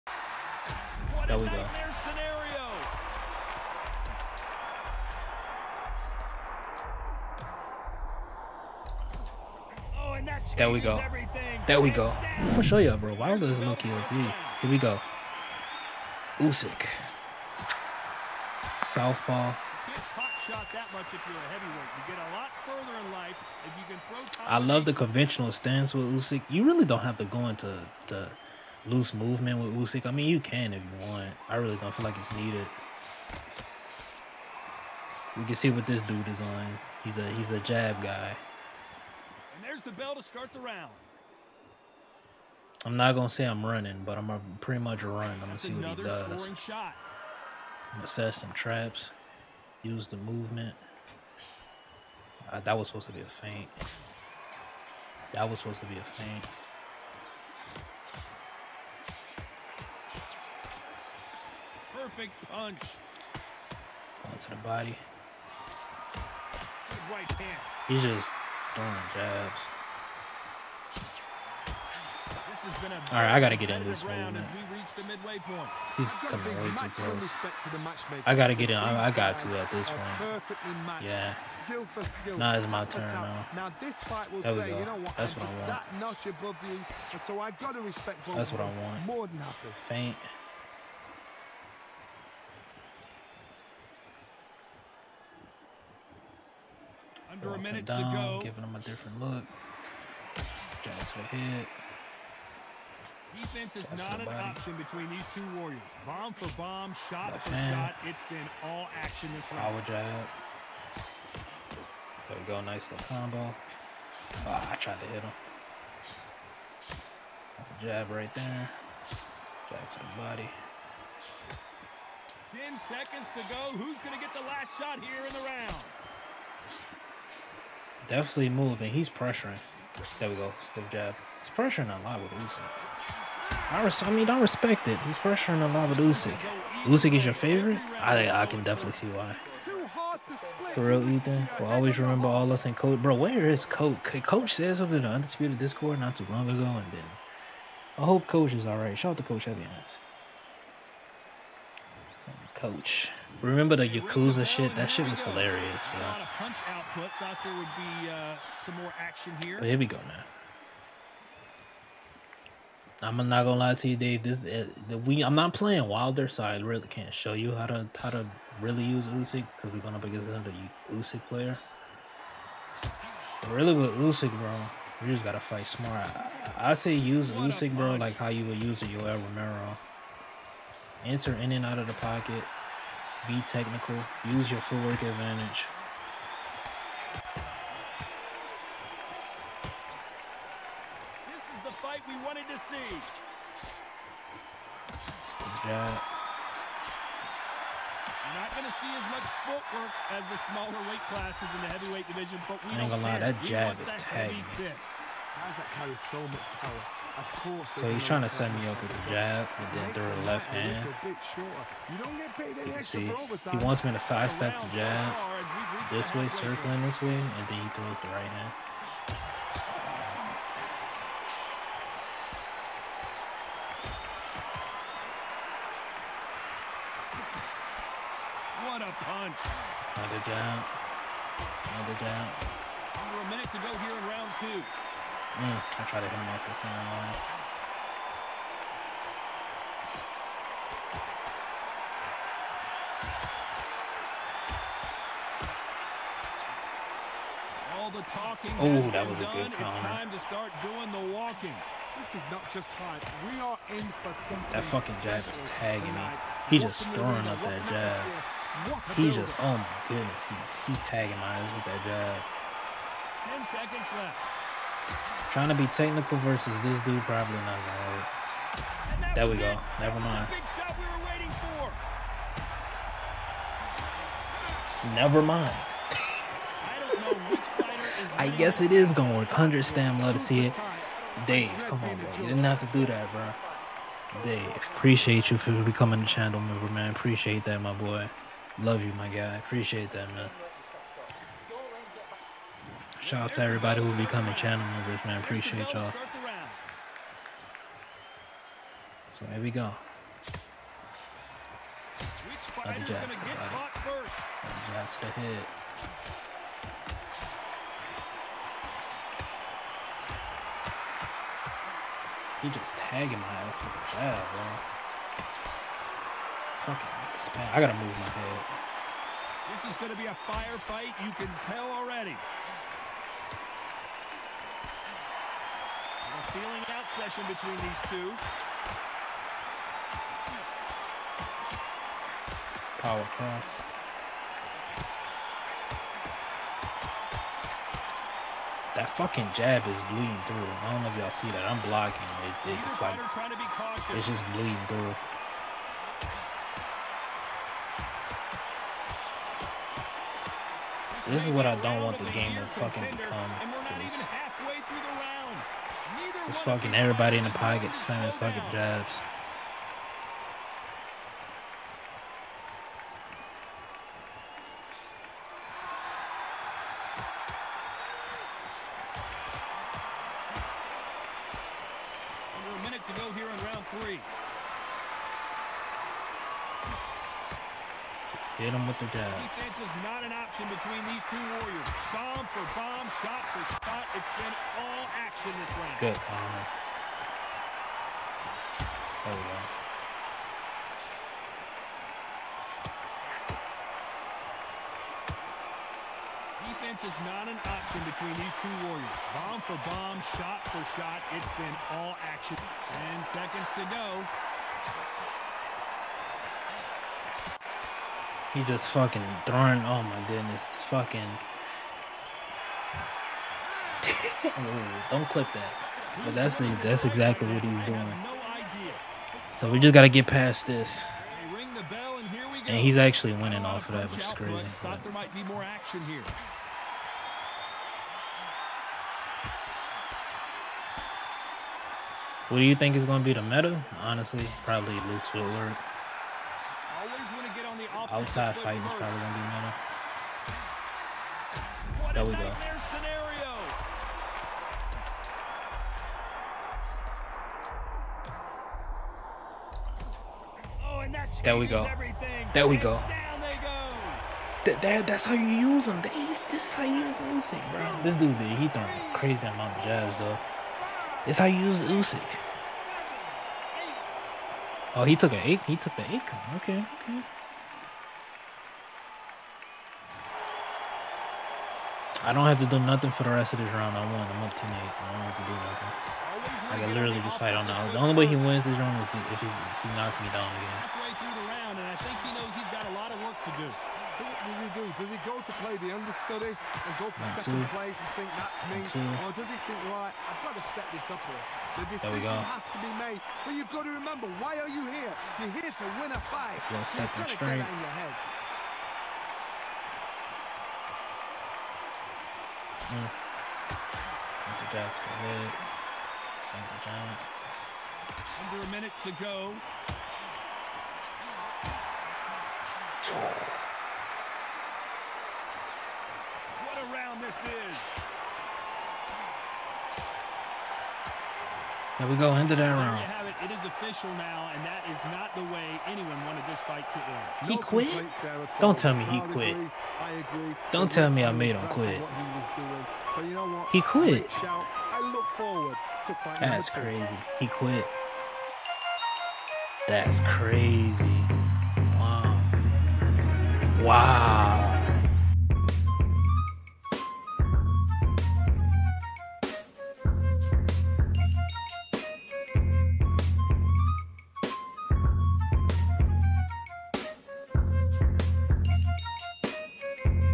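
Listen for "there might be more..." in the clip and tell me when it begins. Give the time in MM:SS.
07:04.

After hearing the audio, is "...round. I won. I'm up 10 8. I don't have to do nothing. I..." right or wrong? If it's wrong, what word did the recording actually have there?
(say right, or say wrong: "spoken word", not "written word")
right.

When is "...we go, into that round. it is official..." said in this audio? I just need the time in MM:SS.
08:41.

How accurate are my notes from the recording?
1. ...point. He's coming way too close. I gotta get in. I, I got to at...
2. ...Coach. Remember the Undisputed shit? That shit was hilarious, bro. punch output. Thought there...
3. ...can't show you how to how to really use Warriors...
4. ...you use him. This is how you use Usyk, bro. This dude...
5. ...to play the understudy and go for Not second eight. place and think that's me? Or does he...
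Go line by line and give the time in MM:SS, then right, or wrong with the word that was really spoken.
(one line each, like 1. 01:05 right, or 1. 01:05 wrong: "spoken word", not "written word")
1. 01:15 right
2. 02:32 wrong: "Yakuza", not "Undisputed"
3. 02:46 wrong: "Usyk", not "Warriors"
4. 07:35 right
5. 08:05 wrong: "two", not "eight".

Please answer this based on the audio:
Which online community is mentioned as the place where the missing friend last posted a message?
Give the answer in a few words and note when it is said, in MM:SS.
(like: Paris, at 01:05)
Undisputed Discord, at 02:25.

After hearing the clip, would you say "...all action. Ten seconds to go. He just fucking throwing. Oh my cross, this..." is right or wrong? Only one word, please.
wrong.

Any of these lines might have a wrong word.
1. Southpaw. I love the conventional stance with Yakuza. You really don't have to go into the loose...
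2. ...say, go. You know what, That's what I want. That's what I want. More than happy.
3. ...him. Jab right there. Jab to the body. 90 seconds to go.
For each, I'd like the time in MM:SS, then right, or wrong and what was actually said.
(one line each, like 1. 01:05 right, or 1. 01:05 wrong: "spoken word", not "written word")
1. 00:18 wrong: "Usyk", not "Yakuza"
2. 01:24 right
3. 01:55 wrong: "10", not "90".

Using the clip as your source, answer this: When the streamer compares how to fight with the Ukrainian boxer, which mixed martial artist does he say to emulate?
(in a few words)
Yoel Romero.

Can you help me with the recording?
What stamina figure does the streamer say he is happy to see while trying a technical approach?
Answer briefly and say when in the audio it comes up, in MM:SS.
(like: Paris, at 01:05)
100, at 04:39.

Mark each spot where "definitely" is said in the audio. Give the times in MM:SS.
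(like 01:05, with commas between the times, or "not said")
02:08, 02:18.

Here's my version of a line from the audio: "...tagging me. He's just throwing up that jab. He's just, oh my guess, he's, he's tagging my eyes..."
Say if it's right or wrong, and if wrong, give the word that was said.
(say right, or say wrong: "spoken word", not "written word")
wrong: "goodness", not "guess".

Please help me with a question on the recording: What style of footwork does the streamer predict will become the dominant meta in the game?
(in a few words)
loose footwork.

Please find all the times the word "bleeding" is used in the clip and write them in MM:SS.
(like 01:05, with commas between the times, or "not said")
05:39, 05:44.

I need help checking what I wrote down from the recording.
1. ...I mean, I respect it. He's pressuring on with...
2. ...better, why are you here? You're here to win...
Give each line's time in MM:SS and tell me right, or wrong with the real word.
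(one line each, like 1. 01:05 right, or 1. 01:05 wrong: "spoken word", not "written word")
1. 02:14 right
2. 08:13 wrong: "remember", not "better".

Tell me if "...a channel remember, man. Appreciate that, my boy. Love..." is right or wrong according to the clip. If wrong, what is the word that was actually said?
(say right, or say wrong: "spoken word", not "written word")
wrong: "member", not "remember".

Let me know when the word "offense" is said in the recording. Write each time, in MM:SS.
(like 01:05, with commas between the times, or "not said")
not said.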